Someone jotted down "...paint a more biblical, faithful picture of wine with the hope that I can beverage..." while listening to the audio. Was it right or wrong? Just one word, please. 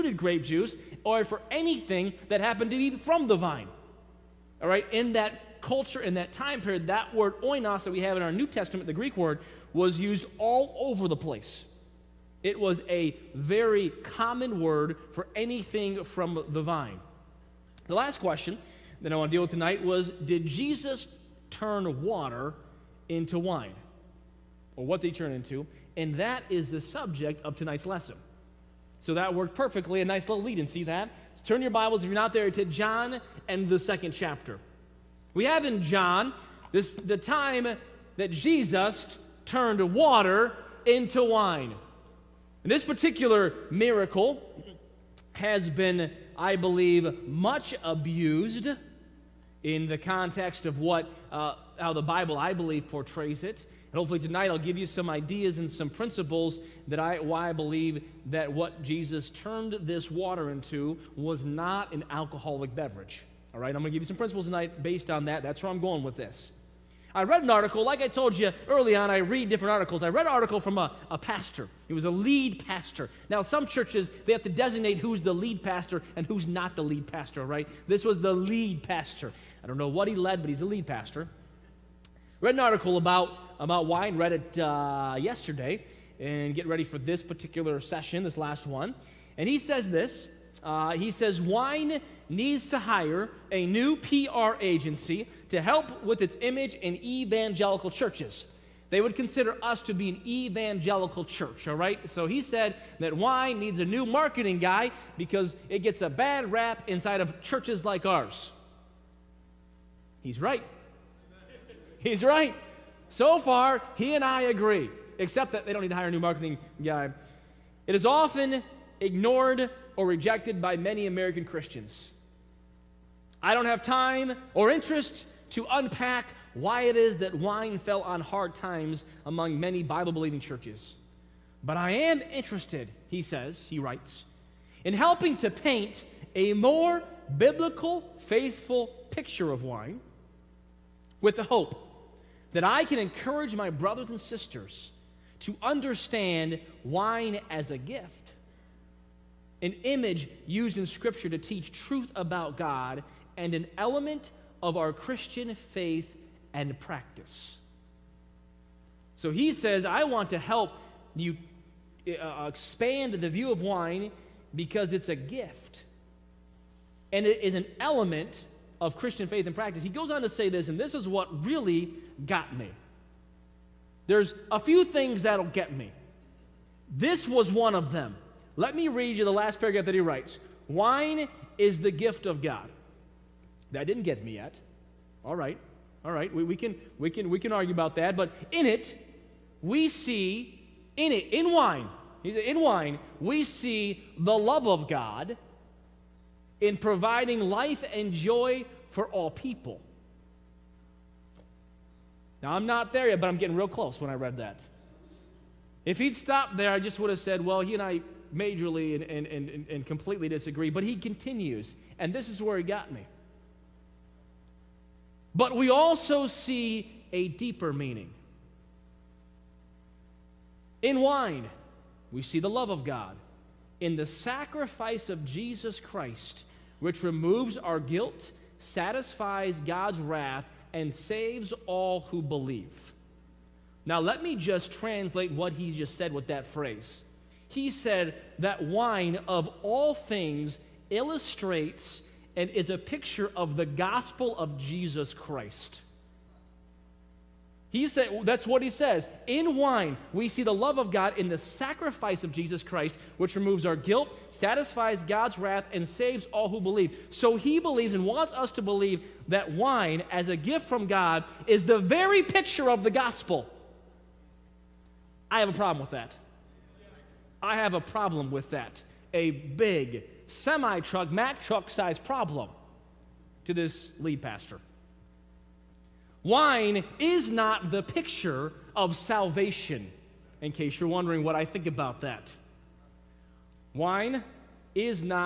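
wrong.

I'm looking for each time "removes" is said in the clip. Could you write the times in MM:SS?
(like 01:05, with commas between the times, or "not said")
03:47, 04:13.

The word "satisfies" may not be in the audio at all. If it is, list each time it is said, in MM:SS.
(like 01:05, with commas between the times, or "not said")
03:48, 04:14.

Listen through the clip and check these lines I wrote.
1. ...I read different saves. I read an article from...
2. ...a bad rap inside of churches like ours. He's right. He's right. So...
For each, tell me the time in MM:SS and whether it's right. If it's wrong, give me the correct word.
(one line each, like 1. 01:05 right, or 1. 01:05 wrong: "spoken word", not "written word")
1. 01:09 wrong: "articles", not "saves"
2. 01:45 right.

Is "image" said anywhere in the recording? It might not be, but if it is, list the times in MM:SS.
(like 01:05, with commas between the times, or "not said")
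01:36, 02:29.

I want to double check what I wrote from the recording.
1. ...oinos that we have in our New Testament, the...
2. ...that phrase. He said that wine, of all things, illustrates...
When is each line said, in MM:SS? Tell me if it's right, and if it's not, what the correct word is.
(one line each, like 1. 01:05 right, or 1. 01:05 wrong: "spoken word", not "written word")
1. 00:07 right
2. 03:56 right.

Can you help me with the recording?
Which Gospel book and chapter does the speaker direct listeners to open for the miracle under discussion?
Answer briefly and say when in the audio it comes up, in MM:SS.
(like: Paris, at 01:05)
John chapter 2, at 00:32.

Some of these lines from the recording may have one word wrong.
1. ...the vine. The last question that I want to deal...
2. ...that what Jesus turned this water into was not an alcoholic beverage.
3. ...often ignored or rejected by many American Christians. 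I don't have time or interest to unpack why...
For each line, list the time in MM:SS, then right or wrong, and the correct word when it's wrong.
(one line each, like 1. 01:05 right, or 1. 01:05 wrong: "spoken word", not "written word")
1. 00:16 right
2. 00:58 right
3. 01:58 right.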